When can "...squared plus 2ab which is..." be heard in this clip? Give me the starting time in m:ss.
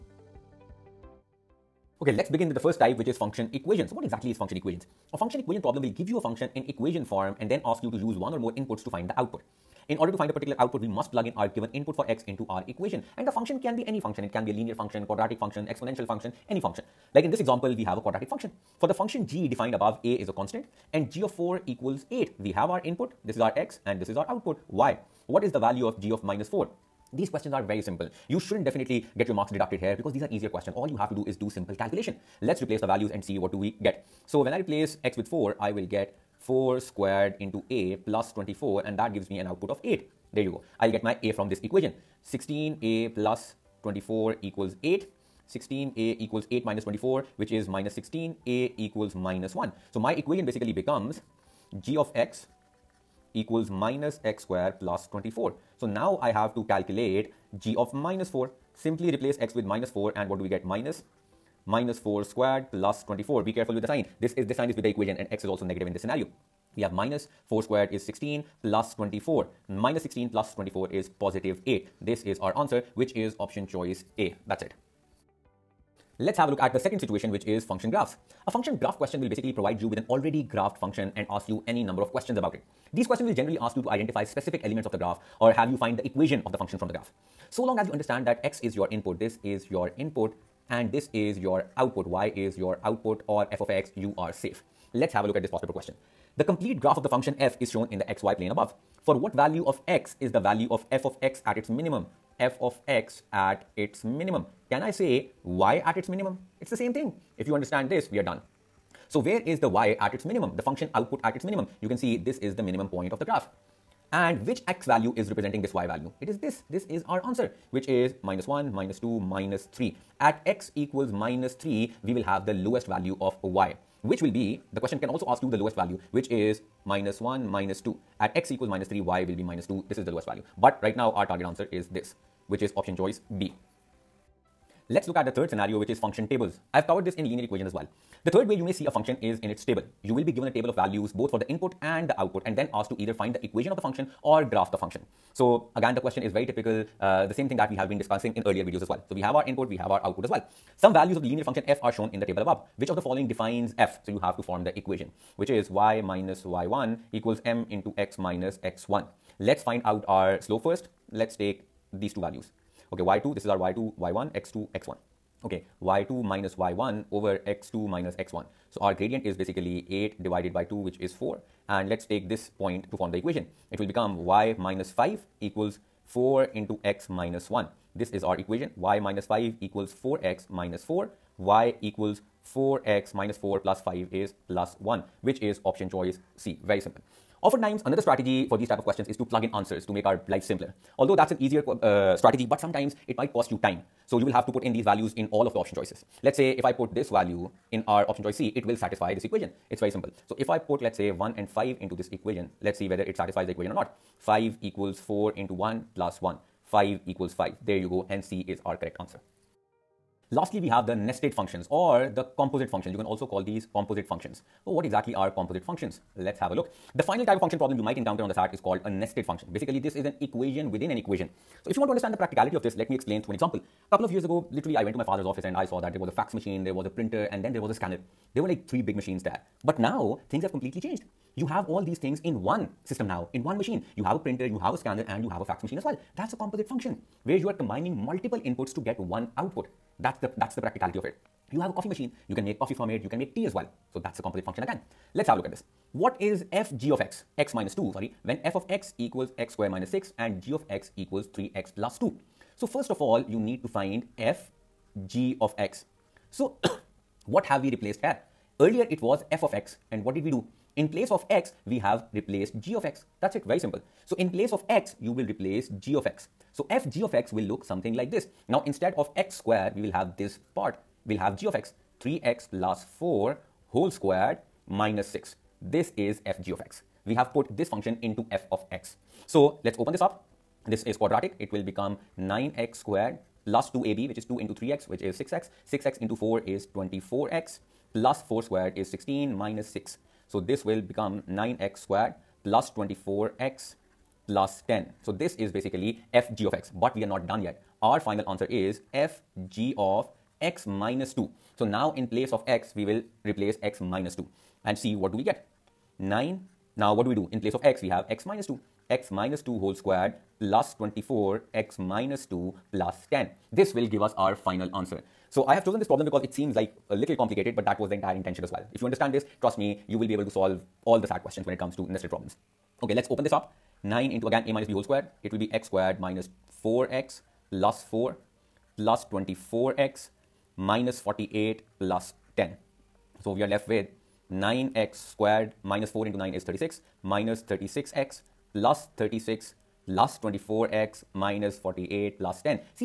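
4:42.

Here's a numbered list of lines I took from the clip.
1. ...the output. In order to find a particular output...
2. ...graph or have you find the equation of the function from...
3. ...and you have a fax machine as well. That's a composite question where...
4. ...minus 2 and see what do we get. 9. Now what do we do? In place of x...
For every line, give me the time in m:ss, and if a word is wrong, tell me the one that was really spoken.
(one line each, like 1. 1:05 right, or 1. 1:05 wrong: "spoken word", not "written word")
1. 0:09 right
2. 1:24 right
3. 3:55 wrong: "function", not "question"
4. 5:03 right.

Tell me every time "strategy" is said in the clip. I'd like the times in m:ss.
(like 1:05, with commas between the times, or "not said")
3:07, 3:12.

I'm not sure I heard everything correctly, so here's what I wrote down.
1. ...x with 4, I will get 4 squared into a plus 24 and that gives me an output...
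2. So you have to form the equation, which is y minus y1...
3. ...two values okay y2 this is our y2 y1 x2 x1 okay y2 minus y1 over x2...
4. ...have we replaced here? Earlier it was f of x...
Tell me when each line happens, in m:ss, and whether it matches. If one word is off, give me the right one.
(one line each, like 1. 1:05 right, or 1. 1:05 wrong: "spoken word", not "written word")
1. 0:35 right
2. 2:34 right
3. 2:42 right
4. 4:17 right.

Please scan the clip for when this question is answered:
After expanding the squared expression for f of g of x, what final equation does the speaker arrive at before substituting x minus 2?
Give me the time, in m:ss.
4:51.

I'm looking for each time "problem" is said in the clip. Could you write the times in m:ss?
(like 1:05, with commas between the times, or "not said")
0:05, 3:37, 5:15, 5:22.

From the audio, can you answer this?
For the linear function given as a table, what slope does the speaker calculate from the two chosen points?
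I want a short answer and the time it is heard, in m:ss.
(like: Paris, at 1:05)
4, at 2:50.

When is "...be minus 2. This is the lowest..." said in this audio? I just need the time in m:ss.
2:09.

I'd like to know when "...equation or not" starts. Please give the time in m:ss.
3:23.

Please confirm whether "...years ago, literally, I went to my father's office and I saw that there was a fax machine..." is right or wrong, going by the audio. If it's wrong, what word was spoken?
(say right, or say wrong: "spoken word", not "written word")
right.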